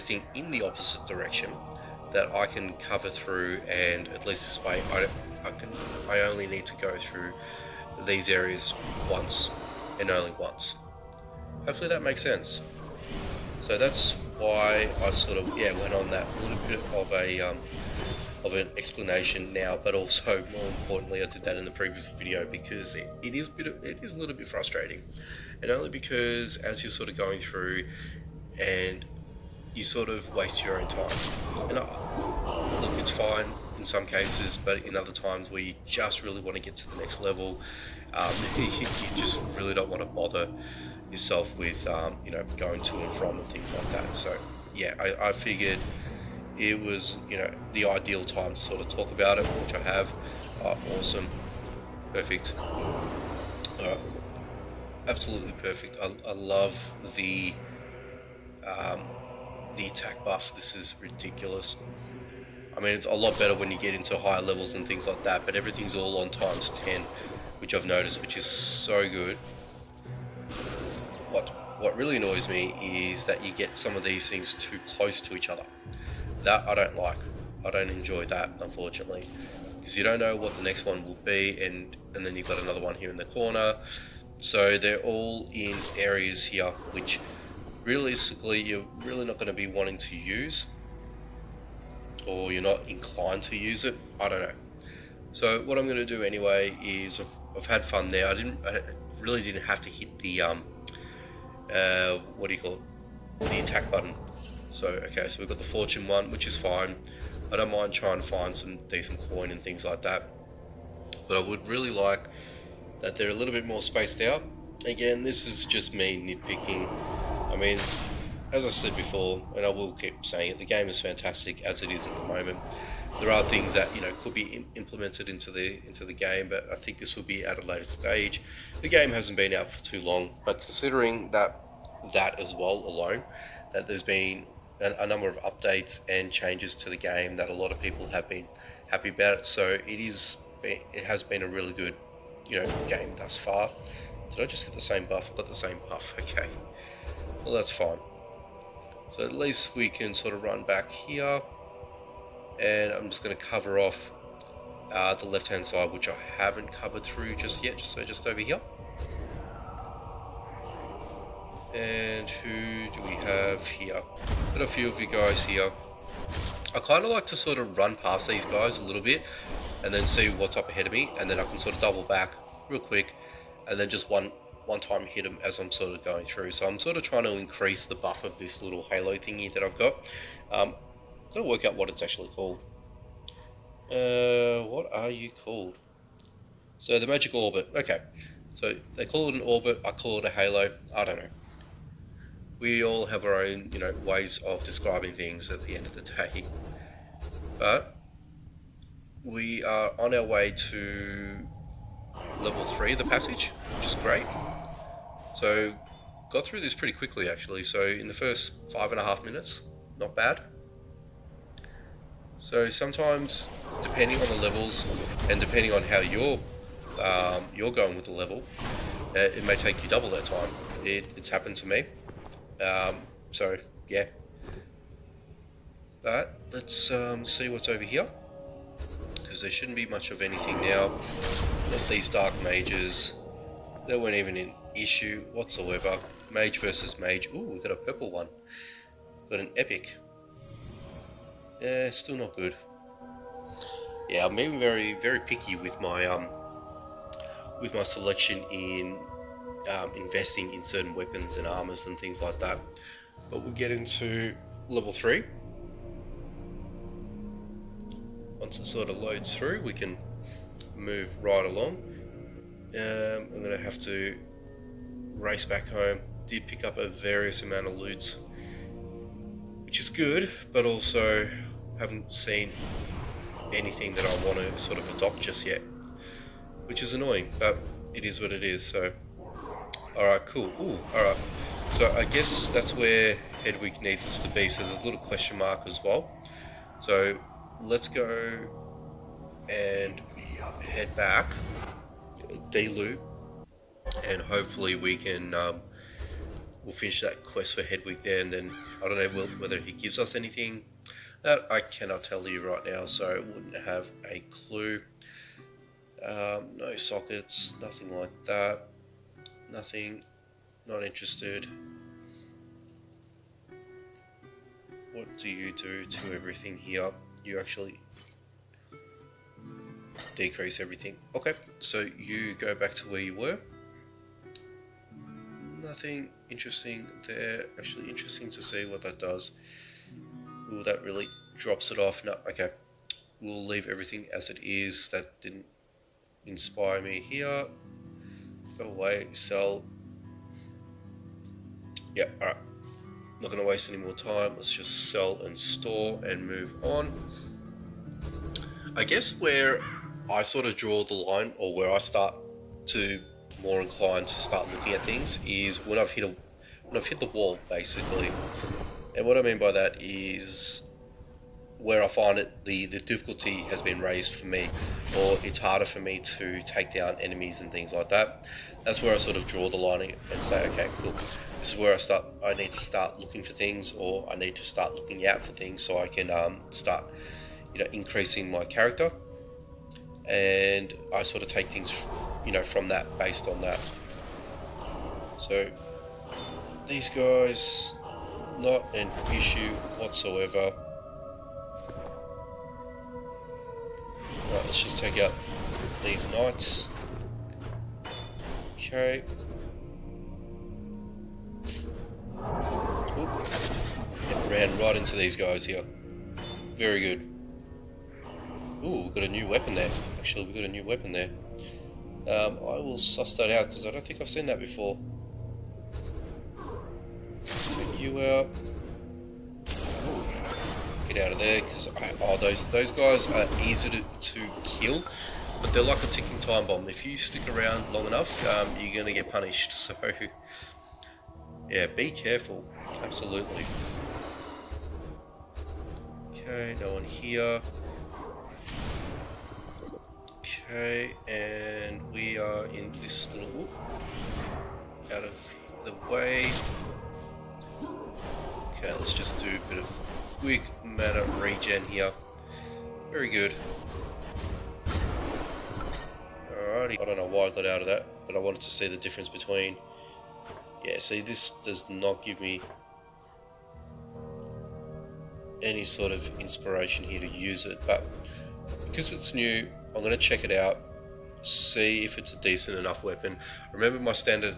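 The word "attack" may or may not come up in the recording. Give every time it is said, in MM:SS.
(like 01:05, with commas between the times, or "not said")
00:59, 01:43.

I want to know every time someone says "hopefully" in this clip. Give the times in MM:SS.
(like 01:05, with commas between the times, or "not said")
00:11, 04:54.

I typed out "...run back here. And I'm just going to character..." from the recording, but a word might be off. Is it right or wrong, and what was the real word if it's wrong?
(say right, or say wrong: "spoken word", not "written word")
wrong: "cover", not "character".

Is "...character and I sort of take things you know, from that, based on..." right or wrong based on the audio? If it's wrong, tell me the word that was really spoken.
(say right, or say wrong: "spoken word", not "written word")
right.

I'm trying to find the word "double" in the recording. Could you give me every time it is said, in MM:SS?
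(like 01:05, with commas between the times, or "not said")
02:51, 03:39.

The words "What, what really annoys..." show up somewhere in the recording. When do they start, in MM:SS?
01:11.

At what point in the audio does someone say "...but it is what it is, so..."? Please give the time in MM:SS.
04:37.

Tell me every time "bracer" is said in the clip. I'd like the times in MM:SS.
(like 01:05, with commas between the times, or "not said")
not said.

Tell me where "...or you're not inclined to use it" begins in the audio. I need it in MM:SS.
01:32.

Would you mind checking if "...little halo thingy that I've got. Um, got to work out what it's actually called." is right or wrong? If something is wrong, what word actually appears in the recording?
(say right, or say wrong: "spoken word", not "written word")
right.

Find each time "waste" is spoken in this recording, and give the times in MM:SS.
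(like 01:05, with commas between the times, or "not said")
00:30, 05:43.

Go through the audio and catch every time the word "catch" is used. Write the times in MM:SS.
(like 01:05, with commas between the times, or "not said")
not said.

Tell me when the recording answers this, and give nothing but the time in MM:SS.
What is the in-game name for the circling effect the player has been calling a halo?
03:07.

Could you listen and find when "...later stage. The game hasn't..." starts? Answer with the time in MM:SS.
02:07.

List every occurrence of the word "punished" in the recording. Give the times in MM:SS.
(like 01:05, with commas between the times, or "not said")
07:09.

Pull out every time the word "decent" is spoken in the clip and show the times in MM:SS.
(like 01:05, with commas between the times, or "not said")
01:48, 07:52.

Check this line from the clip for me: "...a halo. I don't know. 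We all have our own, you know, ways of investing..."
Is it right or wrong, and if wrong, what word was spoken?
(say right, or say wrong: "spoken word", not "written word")
wrong: "describing", not "investing".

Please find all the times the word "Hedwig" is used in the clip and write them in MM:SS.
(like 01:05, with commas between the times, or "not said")
04:43, 04:57.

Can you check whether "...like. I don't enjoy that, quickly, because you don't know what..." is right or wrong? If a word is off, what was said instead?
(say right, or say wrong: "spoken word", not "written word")
wrong: "unfortunately", not "quickly".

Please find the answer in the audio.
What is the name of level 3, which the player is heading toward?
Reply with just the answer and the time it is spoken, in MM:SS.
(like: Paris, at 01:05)
the passage, at 03:22.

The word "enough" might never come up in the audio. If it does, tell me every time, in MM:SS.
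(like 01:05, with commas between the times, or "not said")
07:07, 07:52.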